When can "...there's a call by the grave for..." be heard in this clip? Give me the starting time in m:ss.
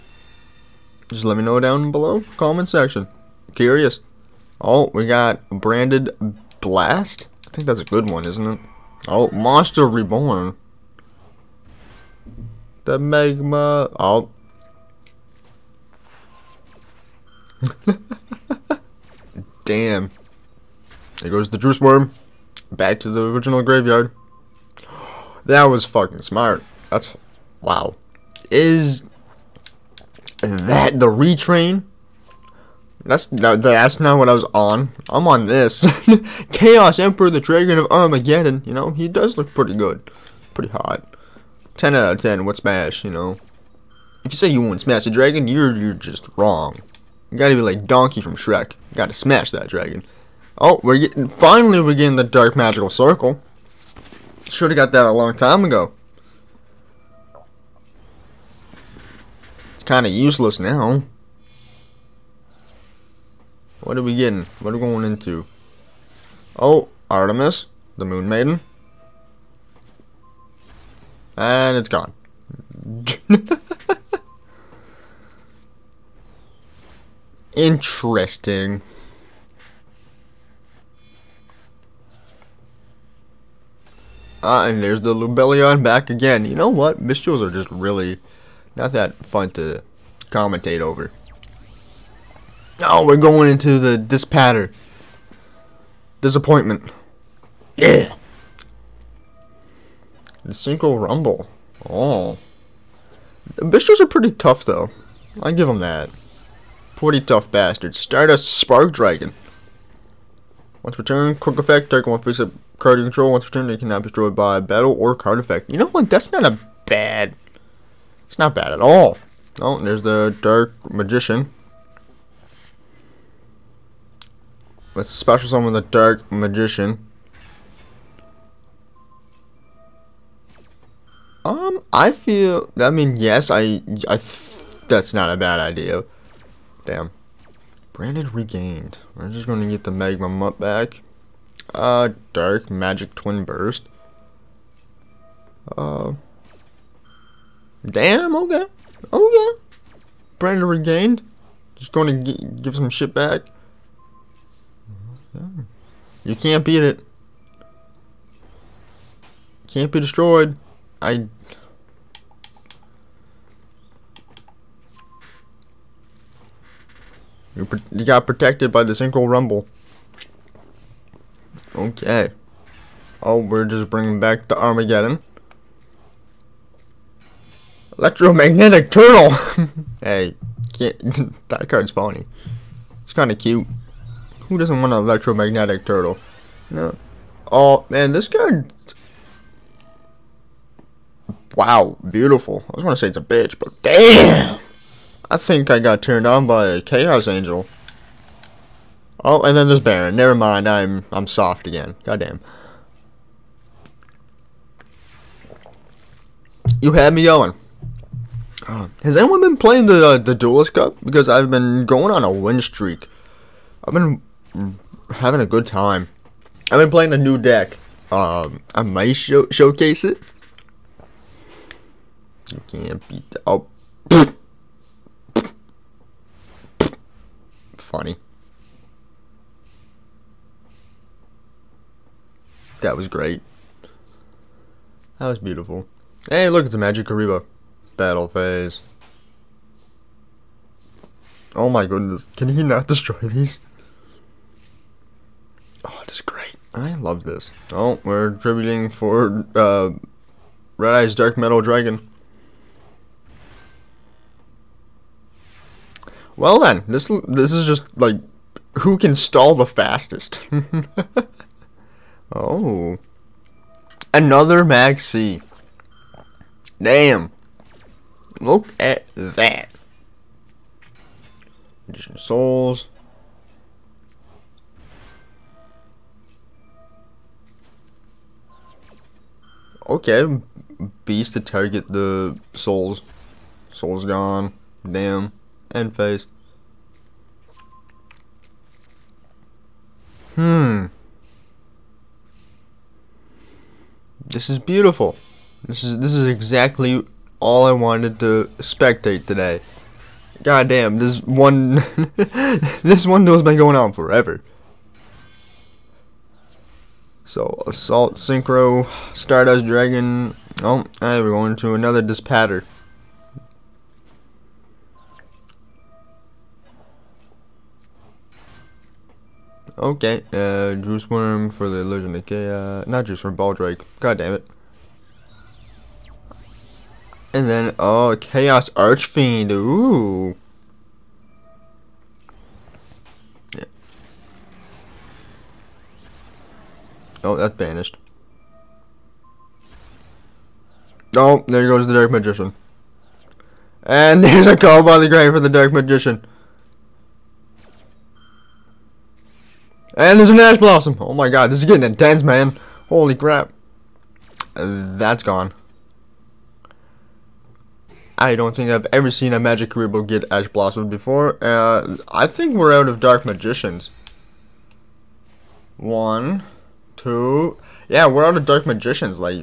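5:44.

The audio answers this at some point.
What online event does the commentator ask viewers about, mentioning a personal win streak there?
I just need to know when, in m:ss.
3:30.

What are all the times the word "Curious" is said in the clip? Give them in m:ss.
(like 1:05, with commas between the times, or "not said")
0:03.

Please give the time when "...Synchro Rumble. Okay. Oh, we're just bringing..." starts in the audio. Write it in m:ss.
2:48.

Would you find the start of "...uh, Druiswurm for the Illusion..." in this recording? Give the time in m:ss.
5:20.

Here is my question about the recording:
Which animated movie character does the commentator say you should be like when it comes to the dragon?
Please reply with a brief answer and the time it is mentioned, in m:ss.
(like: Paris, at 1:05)
Donkey, at 0:47.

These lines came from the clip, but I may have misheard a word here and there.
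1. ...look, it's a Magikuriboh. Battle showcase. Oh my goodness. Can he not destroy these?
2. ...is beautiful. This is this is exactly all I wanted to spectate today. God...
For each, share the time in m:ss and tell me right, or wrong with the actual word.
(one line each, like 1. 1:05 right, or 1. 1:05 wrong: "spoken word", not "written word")
1. 3:56 wrong: "phase", not "showcase"
2. 4:54 right.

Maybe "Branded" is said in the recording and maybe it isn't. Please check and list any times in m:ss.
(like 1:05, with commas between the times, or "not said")
0:05, 2:17, 2:30.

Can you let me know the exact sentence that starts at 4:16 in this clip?
Well then, this this is just like who can stall the fastest.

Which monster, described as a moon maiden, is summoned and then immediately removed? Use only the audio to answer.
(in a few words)
Artemis.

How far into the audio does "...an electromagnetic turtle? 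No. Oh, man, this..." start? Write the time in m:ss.
3:04.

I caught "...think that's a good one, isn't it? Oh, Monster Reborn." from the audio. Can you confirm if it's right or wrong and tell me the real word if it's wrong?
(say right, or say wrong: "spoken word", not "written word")
right.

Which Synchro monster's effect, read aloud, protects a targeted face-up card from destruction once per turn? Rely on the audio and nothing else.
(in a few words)
Stardust Spark Dragon.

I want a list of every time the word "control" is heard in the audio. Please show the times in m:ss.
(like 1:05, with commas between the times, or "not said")
1:52.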